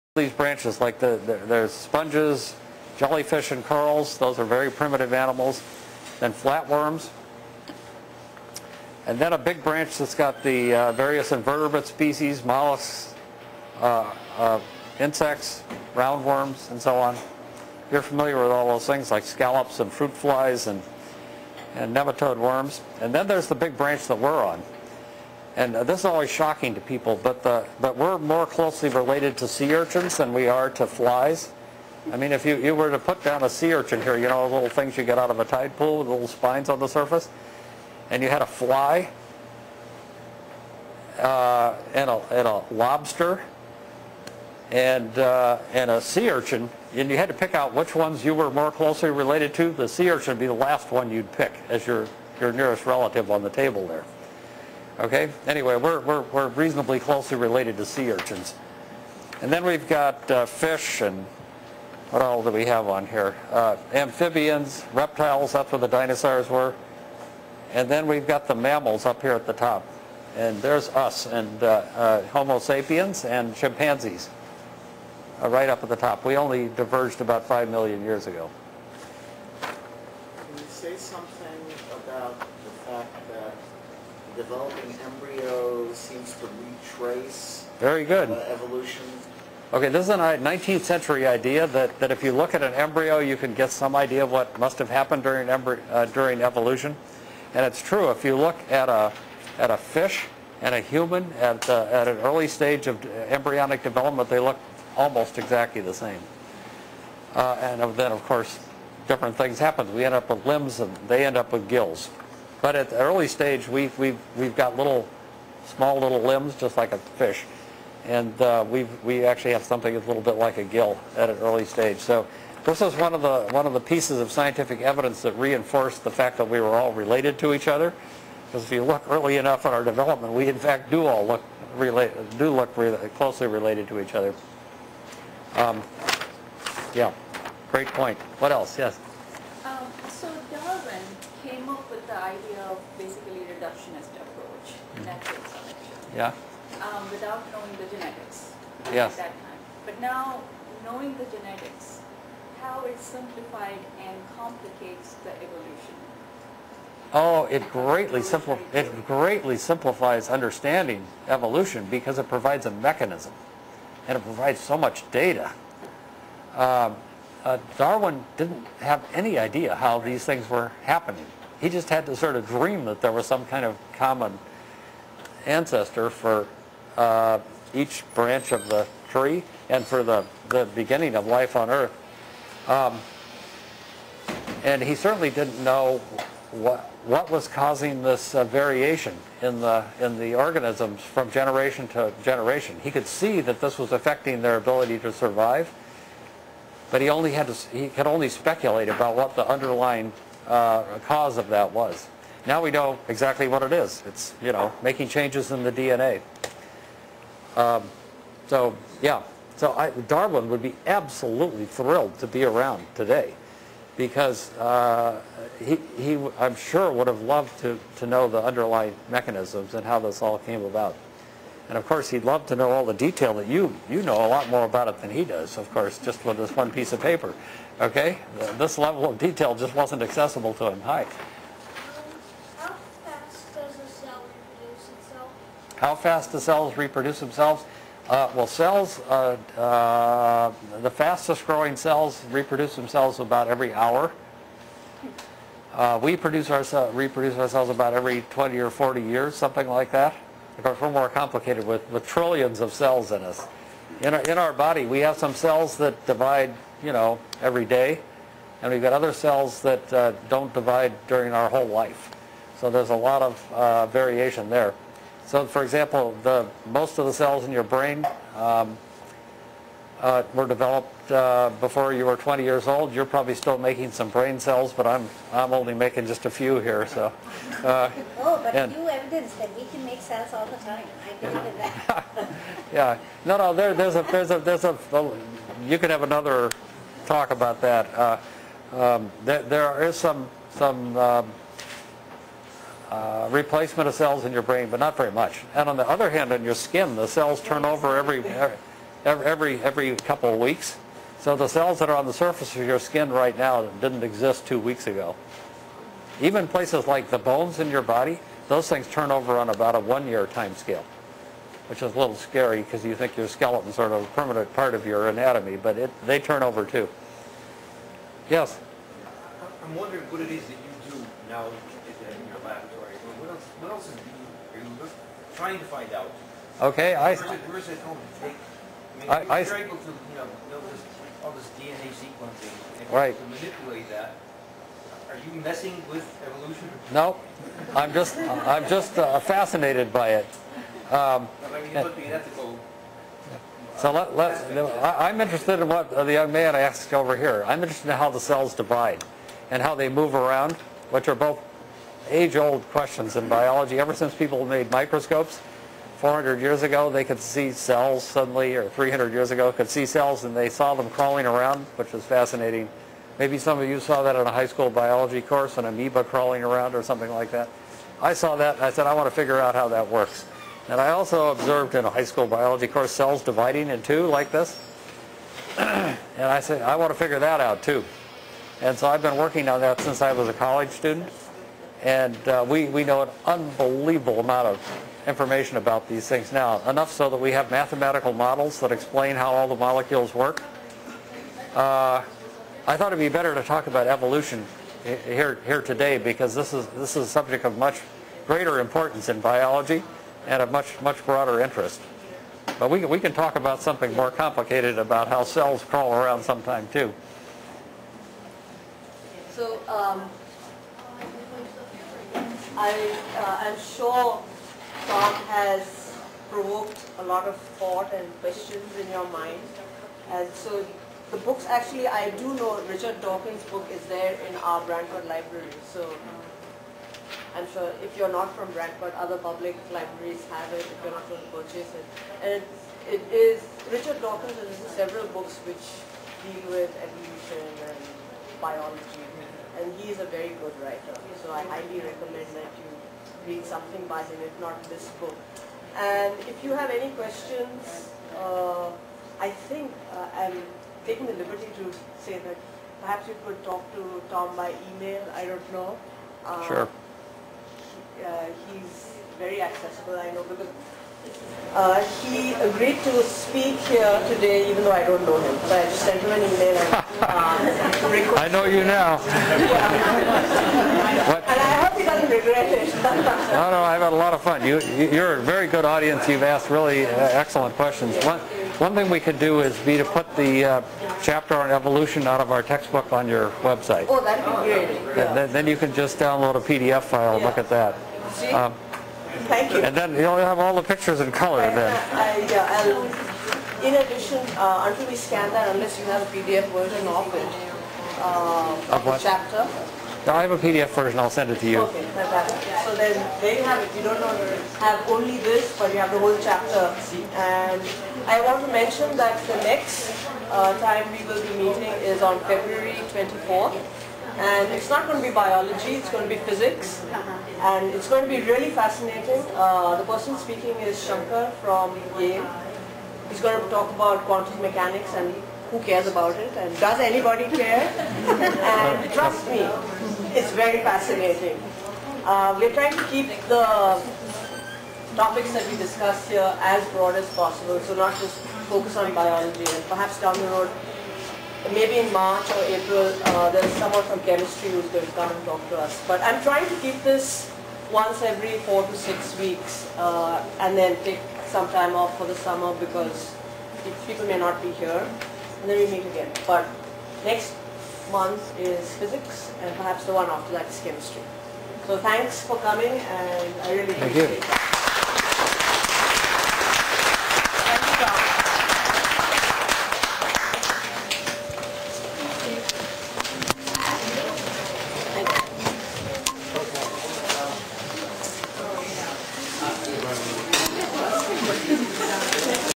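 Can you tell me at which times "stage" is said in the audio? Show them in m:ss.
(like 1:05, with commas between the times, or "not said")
1:42, 1:53, 2:01.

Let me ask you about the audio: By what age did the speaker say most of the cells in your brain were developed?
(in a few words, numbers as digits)
20 years old.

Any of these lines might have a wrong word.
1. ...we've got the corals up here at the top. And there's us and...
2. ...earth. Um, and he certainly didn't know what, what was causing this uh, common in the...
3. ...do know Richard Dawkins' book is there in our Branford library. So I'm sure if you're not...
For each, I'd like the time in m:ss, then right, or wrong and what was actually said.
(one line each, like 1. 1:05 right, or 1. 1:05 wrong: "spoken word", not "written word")
1. 1:08 wrong: "mammals", not "corals"
2. 3:01 wrong: "variation", not "common"
3. 7:02 right.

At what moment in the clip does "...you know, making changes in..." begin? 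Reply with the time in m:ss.
3:24.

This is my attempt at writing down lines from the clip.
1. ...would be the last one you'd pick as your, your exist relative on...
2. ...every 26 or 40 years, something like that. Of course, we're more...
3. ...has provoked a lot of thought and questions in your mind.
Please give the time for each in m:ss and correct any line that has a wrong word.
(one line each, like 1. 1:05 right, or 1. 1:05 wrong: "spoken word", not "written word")
1. 0:50 wrong: "nearest", not "exist"
2. 4:07 wrong: "20", not "26"
3. 6:55 right.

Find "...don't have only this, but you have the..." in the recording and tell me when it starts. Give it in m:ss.
8:23.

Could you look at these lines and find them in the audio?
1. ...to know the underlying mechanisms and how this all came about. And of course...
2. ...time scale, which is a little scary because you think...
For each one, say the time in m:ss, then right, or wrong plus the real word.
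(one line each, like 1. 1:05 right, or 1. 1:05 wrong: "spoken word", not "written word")
1. 3:37 right
2. 5:10 right.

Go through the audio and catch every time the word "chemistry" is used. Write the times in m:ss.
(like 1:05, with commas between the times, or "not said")
9:04, 9:20.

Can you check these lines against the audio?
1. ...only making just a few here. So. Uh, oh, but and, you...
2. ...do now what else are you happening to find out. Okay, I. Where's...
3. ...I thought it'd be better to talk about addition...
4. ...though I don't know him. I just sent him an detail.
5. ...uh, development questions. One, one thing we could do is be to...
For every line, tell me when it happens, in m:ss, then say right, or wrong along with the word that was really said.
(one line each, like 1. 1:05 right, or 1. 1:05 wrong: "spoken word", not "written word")
1. 4:35 right
2. 5:20 wrong: "trying", not "happening"
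3. 6:32 wrong: "evolution", not "addition"
4. 7:44 wrong: "email", not "detail"
5. 7:56 wrong: "excellent", not "development".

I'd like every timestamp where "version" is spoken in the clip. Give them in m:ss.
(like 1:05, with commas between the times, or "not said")
8:16, 8:20.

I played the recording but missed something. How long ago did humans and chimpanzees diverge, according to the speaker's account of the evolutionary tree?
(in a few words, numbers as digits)
About 5 million years.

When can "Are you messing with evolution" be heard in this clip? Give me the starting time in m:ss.
5:35.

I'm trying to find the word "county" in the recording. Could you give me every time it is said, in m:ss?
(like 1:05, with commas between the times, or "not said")
not said.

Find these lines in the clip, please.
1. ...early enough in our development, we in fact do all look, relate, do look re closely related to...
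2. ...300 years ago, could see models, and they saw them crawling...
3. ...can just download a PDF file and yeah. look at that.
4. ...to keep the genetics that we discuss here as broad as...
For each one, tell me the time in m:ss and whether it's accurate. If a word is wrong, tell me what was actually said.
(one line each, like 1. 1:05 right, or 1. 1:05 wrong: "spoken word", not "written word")
1. 2:09 right
2. 5:58 wrong: "cells", not "models"
3. 8:05 right
4. 8:52 wrong: "topics", not "genetics".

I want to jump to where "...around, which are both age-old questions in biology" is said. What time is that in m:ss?
5:50.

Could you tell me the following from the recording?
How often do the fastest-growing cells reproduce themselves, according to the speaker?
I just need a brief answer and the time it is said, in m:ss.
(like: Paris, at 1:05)
About every hour, at 4:03.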